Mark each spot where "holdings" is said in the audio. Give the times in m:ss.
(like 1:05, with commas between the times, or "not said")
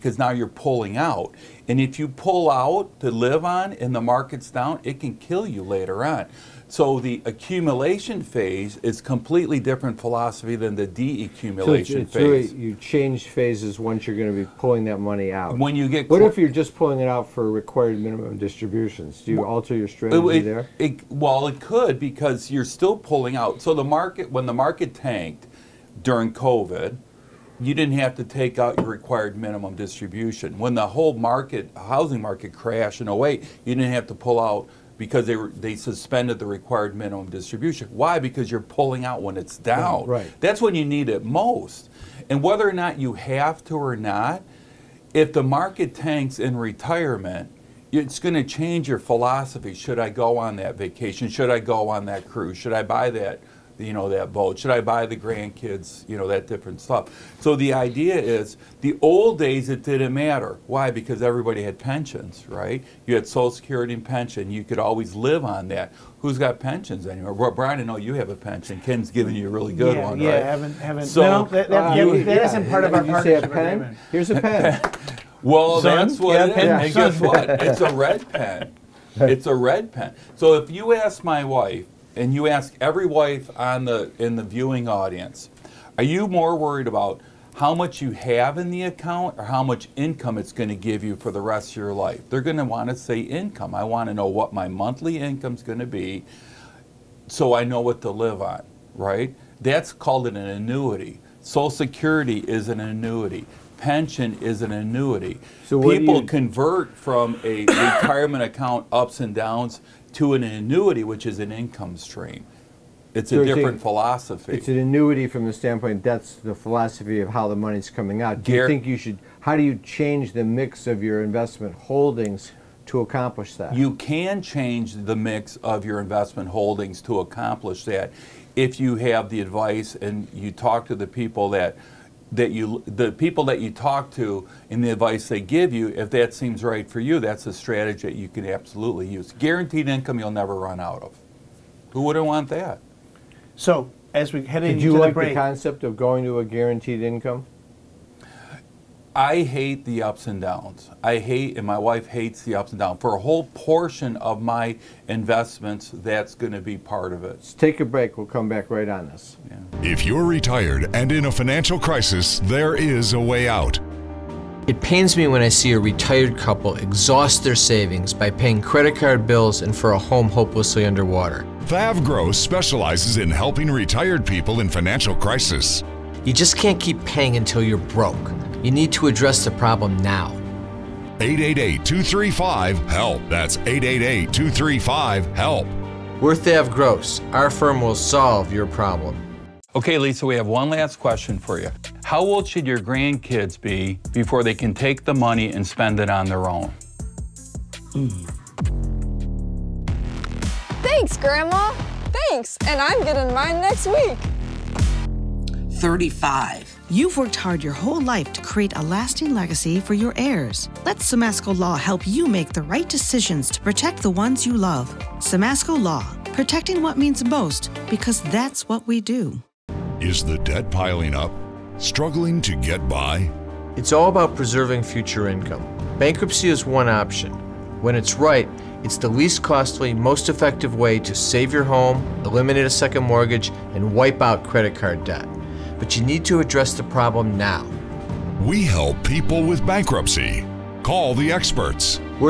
2:01, 2:06.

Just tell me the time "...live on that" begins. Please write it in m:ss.
1:05.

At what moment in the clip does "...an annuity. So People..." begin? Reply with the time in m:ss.
1:44.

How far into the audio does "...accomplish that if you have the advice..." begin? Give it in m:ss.
2:07.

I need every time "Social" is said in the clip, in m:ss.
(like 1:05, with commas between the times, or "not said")
1:03, 1:41.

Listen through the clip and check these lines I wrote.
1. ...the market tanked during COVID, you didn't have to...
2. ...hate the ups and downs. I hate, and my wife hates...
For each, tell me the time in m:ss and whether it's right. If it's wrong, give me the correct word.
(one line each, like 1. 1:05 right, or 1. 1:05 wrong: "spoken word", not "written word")
1. 0:24 right
2. 2:29 right.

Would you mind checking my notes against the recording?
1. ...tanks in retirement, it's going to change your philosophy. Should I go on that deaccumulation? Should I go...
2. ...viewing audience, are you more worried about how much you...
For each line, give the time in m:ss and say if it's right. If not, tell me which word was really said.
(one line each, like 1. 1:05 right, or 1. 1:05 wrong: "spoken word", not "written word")
1. 0:45 wrong: "vacation", not "deaccumulation"
2. 1:24 right.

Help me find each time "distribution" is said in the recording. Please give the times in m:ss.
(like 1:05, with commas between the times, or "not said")
0:18, 0:29, 0:37.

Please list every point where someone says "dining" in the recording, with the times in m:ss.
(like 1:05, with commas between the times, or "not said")
not said.